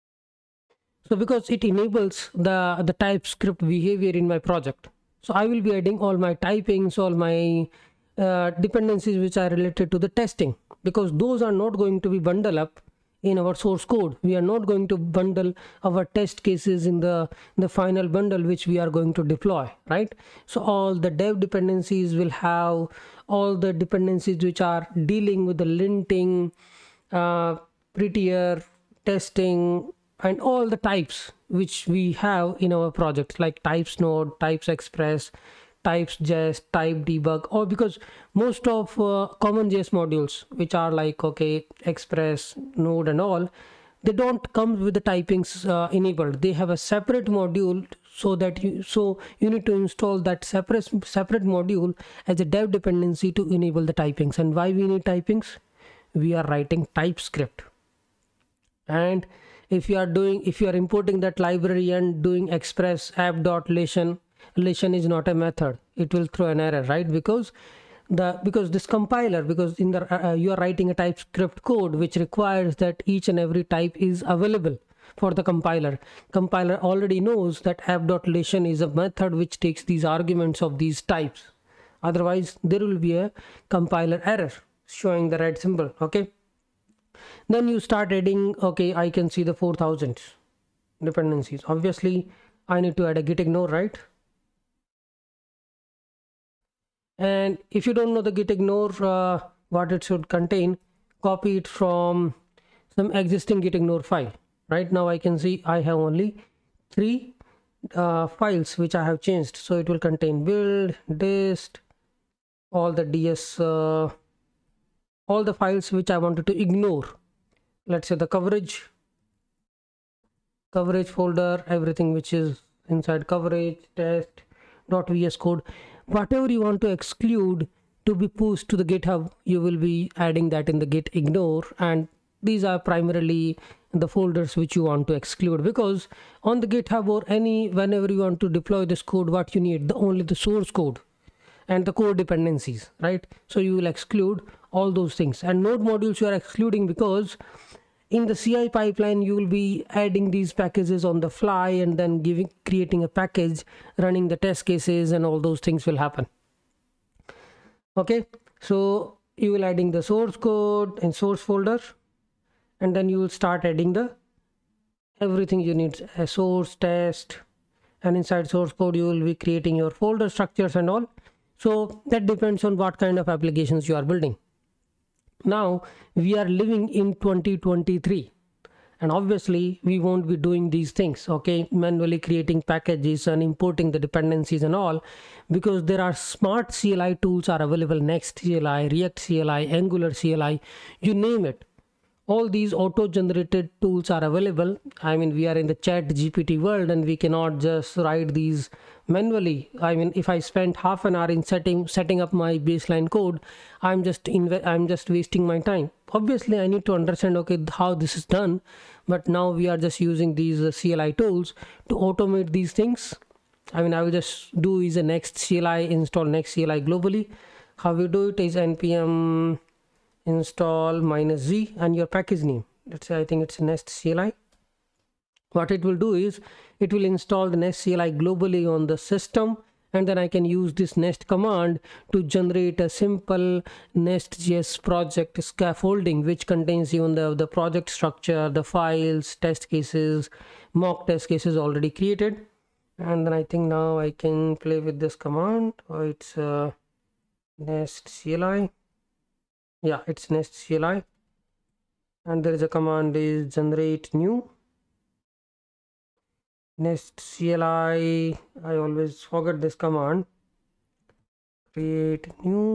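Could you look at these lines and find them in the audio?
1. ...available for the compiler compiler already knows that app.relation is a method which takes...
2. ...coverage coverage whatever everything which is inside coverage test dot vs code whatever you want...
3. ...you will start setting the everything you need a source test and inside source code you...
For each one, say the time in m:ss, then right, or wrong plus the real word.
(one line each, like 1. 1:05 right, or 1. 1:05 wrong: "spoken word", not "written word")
1. 1:14 right
2. 1:58 wrong: "folder", not "whatever"
3. 2:43 wrong: "adding", not "setting".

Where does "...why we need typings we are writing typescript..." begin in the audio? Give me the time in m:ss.
0:54.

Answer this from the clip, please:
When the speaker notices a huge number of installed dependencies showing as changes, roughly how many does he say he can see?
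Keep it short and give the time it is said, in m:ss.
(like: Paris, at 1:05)
4000, at 1:29.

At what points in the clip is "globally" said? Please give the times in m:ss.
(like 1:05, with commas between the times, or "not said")
3:36, 3:48.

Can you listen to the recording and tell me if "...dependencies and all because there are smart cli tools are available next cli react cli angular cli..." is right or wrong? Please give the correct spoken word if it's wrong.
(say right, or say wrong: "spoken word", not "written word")
right.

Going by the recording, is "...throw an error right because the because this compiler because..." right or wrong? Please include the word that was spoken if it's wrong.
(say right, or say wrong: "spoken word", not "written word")
right.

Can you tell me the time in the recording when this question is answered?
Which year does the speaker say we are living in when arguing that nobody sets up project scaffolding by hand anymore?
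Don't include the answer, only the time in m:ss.
2:57.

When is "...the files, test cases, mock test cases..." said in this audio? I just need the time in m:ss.
3:58.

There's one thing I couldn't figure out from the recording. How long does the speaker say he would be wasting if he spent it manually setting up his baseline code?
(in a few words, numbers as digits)
half an hour.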